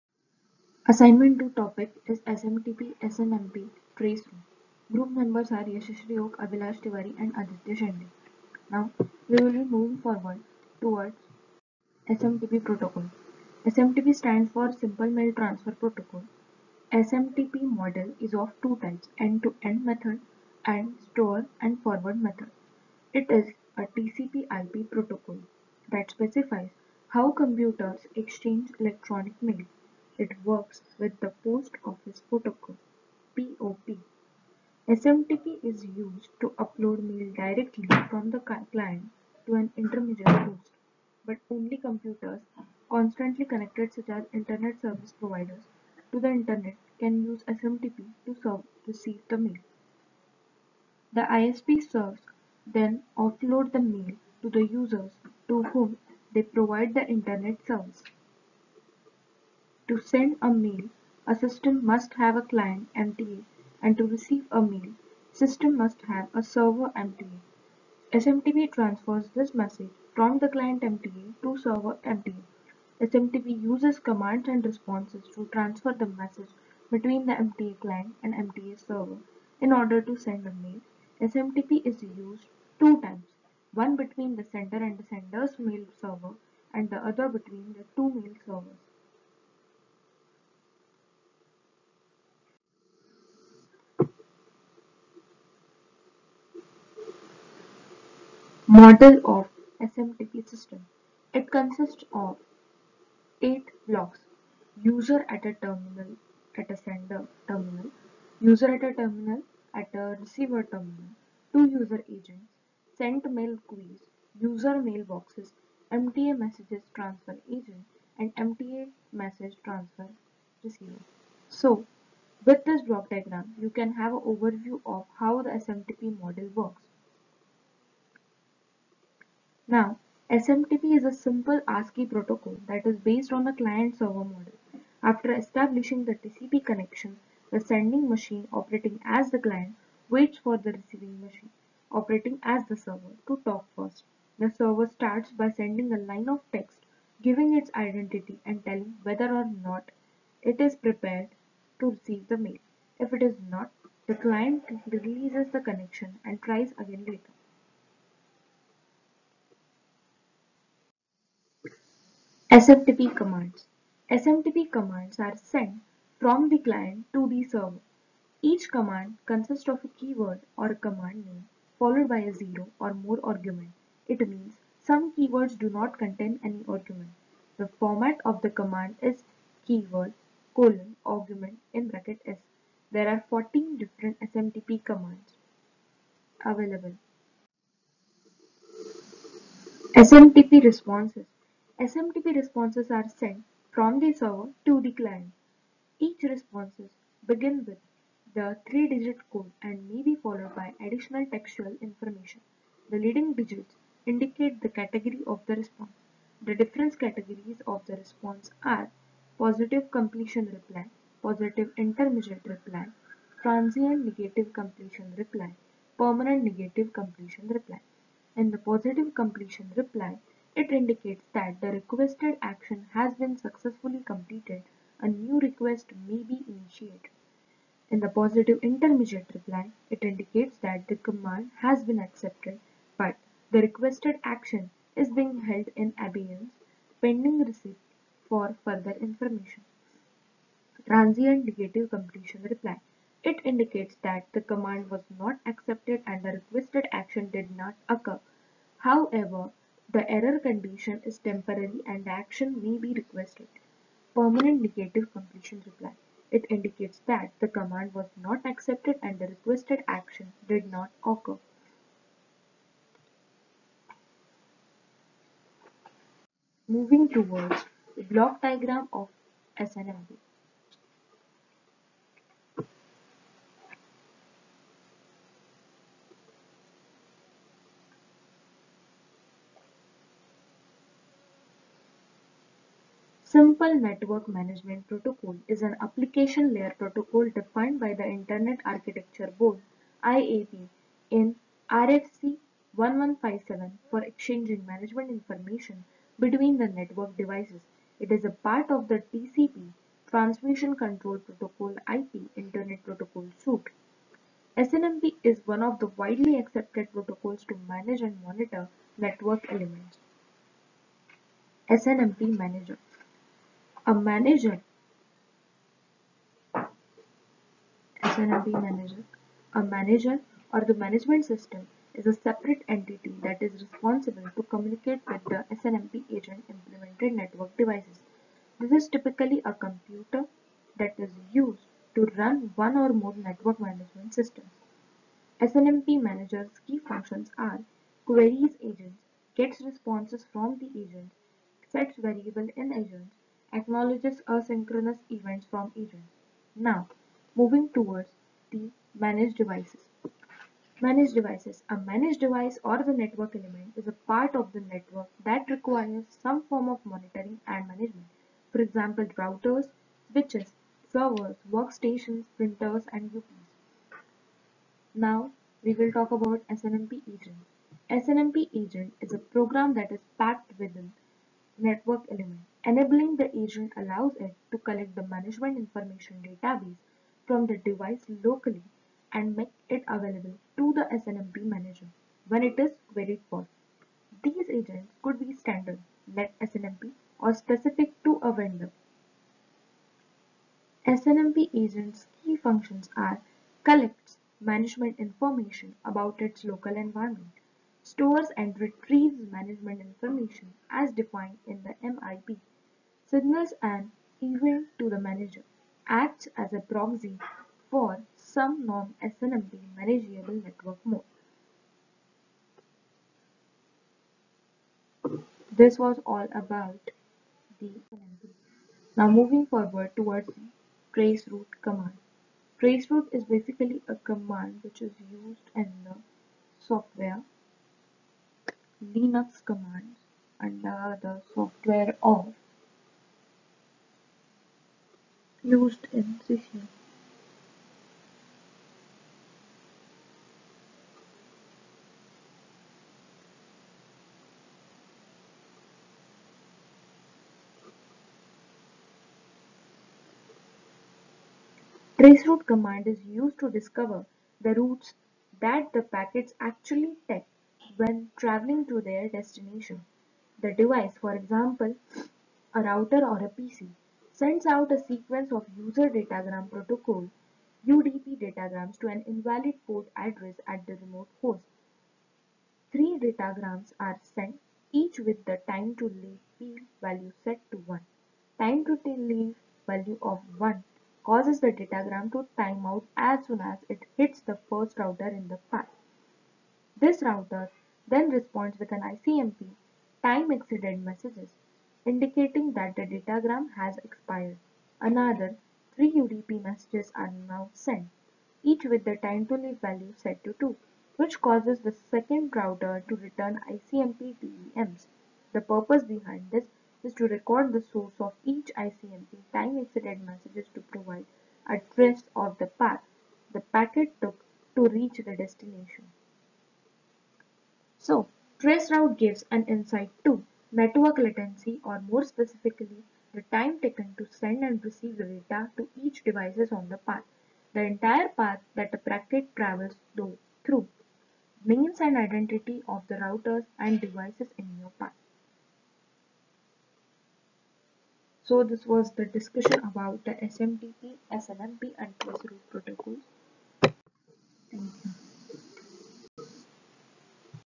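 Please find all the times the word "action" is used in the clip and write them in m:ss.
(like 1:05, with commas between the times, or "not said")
3:42, 3:54, 4:06, 4:12, 4:19.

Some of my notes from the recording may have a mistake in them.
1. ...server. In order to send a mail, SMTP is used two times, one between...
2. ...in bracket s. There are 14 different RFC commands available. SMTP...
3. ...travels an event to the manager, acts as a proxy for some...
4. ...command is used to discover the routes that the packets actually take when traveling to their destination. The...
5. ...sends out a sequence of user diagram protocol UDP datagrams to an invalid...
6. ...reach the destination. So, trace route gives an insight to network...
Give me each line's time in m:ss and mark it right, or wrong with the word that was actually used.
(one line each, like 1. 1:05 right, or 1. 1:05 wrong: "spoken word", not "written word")
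1. 1:18 right
2. 3:01 wrong: "SMTP", not "RFC"
3. 6:43 wrong: "signals", not "travels"
4. 7:32 right
5. 7:44 wrong: "datagram", not "diagram"
6. 8:34 right.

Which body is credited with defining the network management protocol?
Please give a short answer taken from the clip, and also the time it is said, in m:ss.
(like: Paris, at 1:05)
Internet Architecture Board, at 4:48.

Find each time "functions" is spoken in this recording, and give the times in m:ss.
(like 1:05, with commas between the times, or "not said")
5:36, 6:32.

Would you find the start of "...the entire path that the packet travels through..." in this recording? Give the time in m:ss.
8:47.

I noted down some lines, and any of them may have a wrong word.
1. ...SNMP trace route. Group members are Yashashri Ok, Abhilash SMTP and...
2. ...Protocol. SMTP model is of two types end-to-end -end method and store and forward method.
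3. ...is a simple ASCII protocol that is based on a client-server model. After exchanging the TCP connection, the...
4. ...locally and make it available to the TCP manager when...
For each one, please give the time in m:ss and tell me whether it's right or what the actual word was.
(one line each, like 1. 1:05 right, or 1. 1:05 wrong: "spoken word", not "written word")
1. 0:03 wrong: "Tiwari", not "SMTP"
2. 0:15 right
3. 2:10 wrong: "establishing", not "exchanging"
4. 6:18 wrong: "SNMP", not "TCP".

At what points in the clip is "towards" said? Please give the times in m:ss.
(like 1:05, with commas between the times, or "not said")
0:10, 4:27, 5:47, 6:59.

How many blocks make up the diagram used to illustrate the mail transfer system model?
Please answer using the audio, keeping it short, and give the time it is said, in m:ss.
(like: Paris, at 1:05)
8, at 1:43.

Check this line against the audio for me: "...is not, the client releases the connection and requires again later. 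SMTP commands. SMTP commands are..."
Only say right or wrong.
wrong.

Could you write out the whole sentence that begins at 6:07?
SNMP agent is a program that is packed within network element.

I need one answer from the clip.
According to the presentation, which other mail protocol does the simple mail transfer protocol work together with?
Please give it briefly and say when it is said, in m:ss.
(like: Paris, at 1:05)
Post Office Protocol, at 0:31.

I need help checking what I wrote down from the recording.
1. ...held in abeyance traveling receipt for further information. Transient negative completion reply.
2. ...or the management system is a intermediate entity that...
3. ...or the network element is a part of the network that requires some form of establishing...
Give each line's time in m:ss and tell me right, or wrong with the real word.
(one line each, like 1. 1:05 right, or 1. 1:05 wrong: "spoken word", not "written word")
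1. 3:55 wrong: "pending", not "traveling"
2. 5:20 wrong: "separate", not "intermediate"
3. 5:52 wrong: "monitoring", not "establishing".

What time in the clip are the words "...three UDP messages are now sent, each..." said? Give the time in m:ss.
8:15.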